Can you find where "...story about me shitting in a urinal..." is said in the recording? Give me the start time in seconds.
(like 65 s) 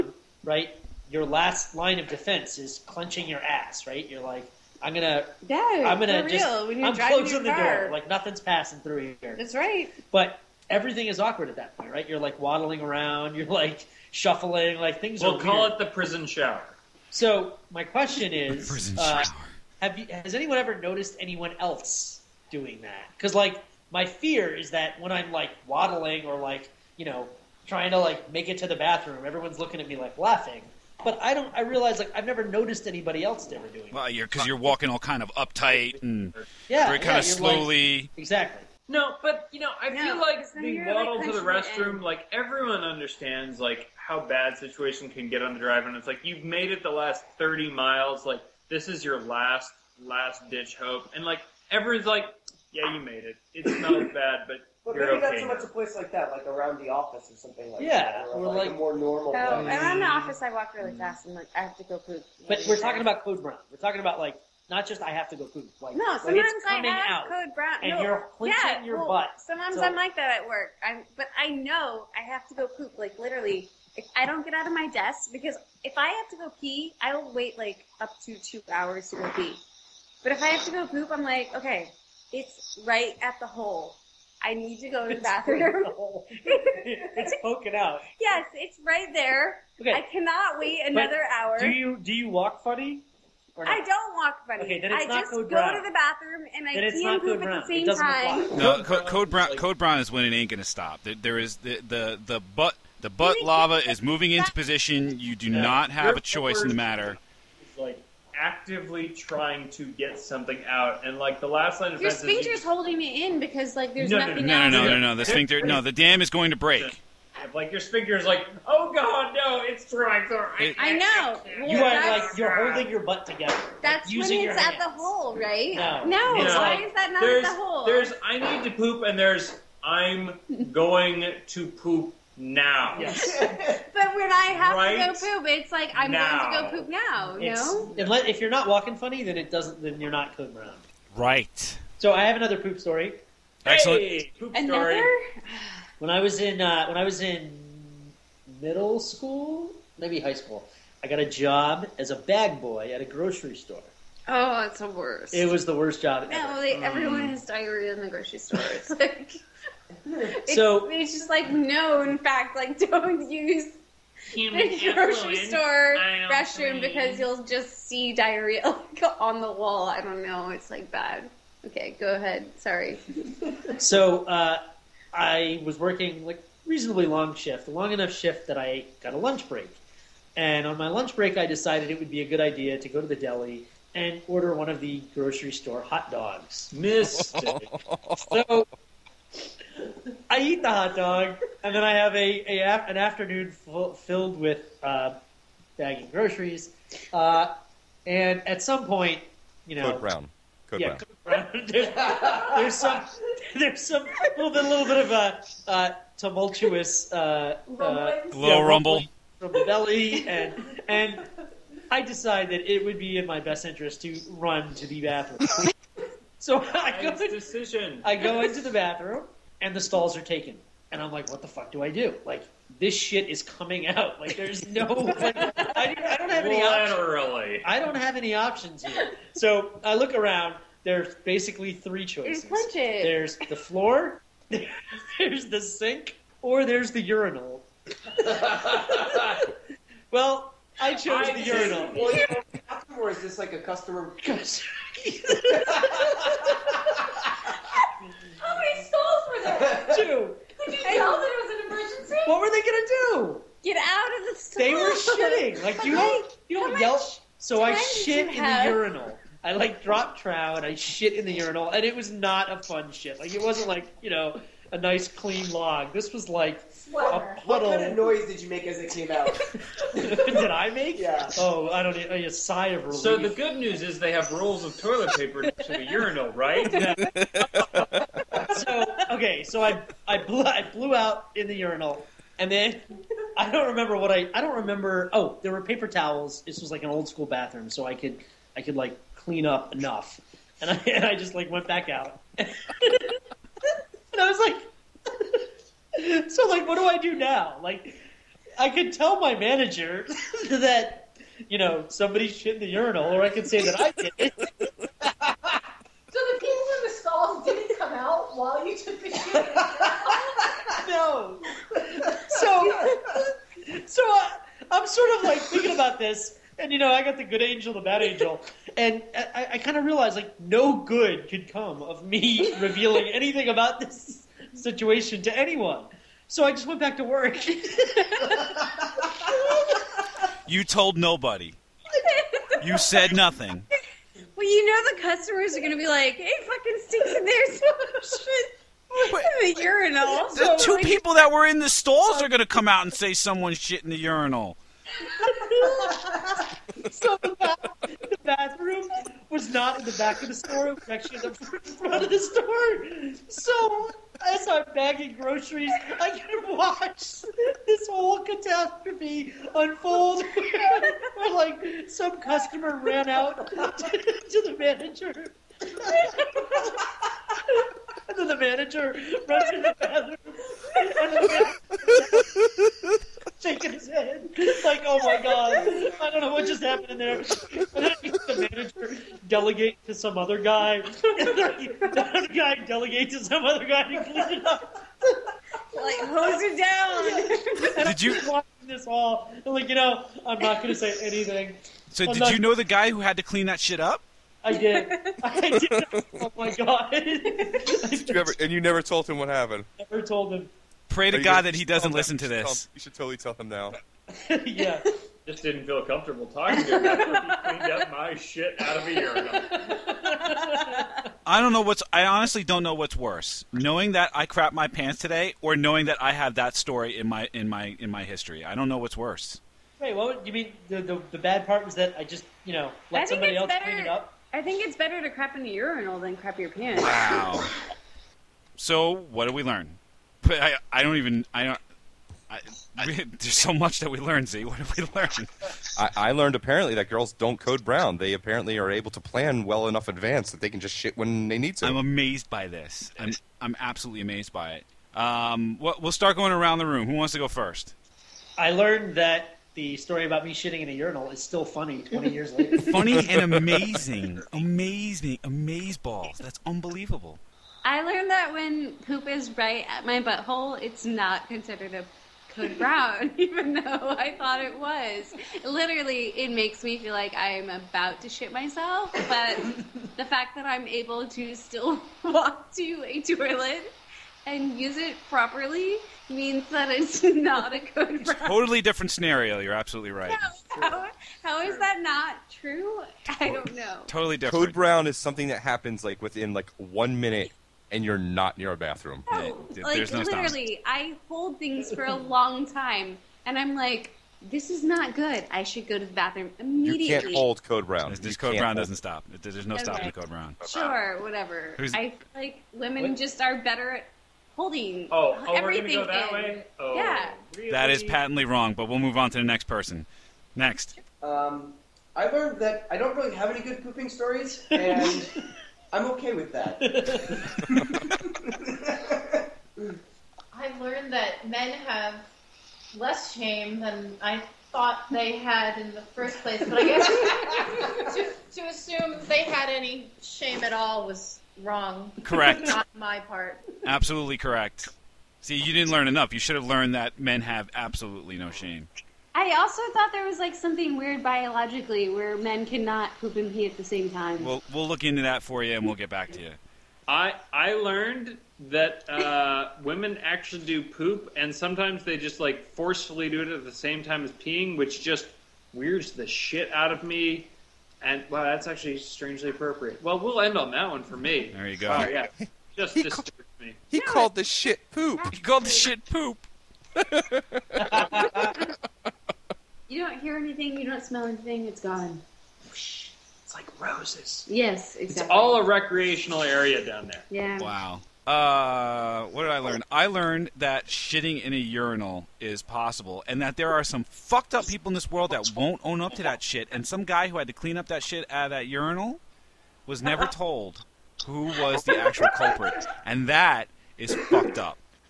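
449 s.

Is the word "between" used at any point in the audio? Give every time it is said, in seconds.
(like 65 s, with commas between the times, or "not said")
not said.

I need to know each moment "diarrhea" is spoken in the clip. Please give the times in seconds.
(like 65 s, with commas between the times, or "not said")
157 s, 168 s.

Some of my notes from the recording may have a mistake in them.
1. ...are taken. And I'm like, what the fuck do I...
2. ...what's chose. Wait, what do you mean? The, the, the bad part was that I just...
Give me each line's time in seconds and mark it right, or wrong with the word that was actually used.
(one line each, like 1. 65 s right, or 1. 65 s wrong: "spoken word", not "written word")
1. 220 s right
2. 418 s wrong: "worse", not "chose".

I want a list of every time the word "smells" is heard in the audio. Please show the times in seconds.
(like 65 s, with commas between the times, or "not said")
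53 s, 570 s.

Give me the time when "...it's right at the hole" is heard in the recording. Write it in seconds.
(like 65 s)
82 s.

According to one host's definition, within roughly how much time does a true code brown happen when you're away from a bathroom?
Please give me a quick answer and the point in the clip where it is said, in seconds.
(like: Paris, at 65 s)
one minute, at 486 s.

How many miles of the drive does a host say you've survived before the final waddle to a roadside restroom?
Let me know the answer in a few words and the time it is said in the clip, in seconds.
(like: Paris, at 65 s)
30, at 47 s.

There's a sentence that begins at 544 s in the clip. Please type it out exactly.
We'll we'll look into that for you, and we'll get back to you.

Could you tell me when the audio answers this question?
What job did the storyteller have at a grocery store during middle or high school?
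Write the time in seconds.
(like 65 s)
152 s.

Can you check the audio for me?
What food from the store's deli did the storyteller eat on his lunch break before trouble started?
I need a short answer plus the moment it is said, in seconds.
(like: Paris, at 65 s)
hot dog, at 185 s.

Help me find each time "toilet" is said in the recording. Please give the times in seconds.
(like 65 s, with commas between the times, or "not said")
274 s, 473 s.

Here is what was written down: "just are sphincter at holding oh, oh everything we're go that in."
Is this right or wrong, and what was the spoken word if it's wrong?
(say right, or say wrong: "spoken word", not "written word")
wrong: "better", not "sphincter".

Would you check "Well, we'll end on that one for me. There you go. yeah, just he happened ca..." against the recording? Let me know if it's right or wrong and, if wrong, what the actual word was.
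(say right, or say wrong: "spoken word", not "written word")
wrong: "disturbed", not "happened".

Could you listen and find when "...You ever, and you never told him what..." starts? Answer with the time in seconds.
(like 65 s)
396 s.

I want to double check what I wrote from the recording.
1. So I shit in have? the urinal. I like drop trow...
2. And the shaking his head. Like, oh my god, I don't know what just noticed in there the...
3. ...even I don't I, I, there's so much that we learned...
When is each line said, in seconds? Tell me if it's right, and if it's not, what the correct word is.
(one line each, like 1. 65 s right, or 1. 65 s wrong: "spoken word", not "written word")
1. 257 s right
2. 370 s wrong: "happened", not "noticed"
3. 430 s right.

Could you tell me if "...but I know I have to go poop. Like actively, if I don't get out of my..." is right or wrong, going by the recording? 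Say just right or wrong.
wrong.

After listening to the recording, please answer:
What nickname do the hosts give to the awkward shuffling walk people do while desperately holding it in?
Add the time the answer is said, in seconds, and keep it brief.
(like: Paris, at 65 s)
prison shower, at 15 s.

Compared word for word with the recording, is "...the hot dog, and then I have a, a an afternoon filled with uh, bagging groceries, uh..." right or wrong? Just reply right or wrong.
right.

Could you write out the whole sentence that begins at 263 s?
Like it wasn't like you know a nice clean log.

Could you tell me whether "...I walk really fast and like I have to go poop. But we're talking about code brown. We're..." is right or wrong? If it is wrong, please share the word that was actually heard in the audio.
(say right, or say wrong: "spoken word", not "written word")
right.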